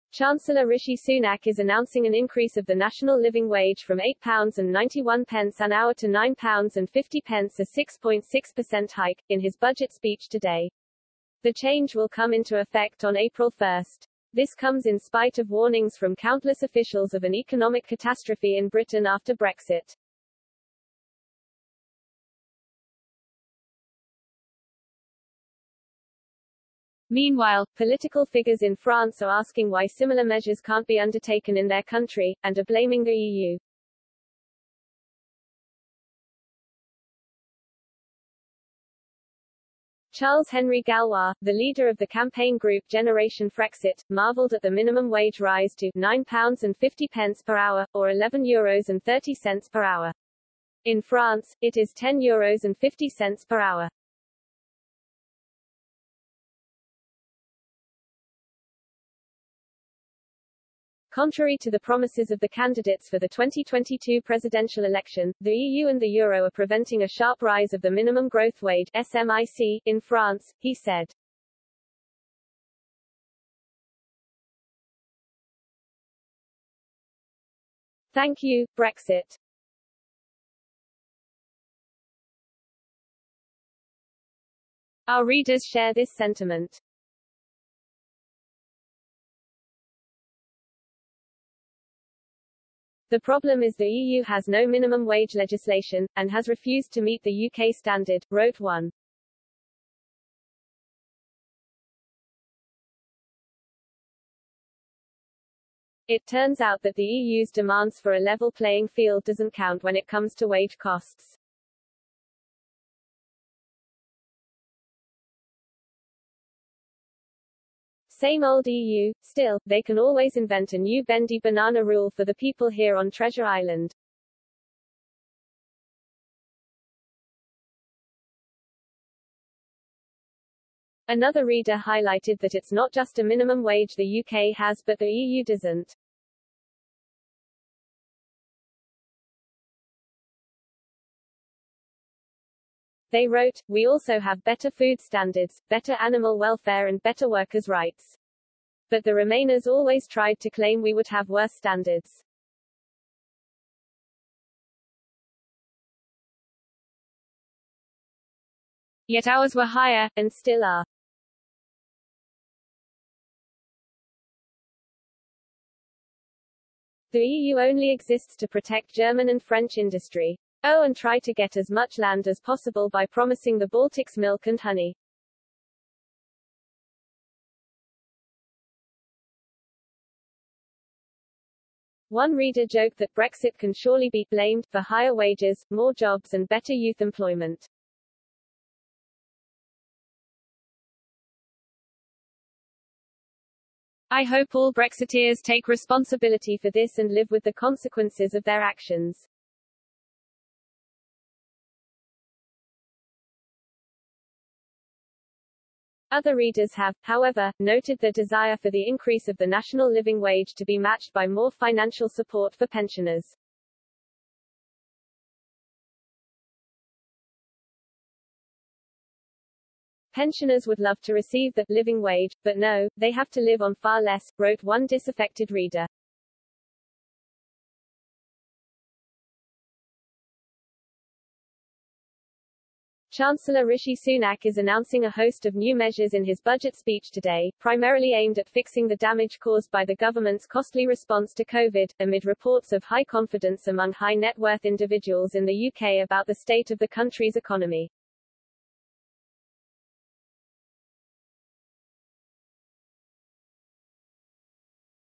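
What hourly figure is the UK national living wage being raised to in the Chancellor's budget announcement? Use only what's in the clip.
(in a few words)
£9.50.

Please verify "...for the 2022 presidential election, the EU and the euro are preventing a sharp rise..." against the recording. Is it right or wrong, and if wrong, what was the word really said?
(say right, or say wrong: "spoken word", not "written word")
right.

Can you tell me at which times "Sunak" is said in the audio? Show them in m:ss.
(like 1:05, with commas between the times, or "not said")
0:00, 3:53.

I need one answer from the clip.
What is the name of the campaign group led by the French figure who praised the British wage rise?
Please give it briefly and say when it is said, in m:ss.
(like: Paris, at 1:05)
Generation Frexit, at 0:42.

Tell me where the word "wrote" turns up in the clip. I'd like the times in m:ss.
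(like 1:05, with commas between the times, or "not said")
1:38, 2:23, 3:44.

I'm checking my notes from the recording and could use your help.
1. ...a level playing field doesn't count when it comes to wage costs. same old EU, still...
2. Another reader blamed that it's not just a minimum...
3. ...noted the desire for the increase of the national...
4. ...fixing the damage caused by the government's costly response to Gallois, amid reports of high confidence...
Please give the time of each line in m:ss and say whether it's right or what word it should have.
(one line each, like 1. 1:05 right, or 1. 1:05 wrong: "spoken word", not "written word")
1. 1:48 right
2. 2:11 wrong: "highlighted", not "blamed"
3. 3:27 right
4. 3:58 wrong: "COVID", not "Gallois".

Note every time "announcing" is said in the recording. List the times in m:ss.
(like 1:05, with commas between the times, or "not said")
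0:01, 3:54.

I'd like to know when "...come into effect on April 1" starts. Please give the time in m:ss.
0:12.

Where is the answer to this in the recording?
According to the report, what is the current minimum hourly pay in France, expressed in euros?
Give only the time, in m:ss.
0:51.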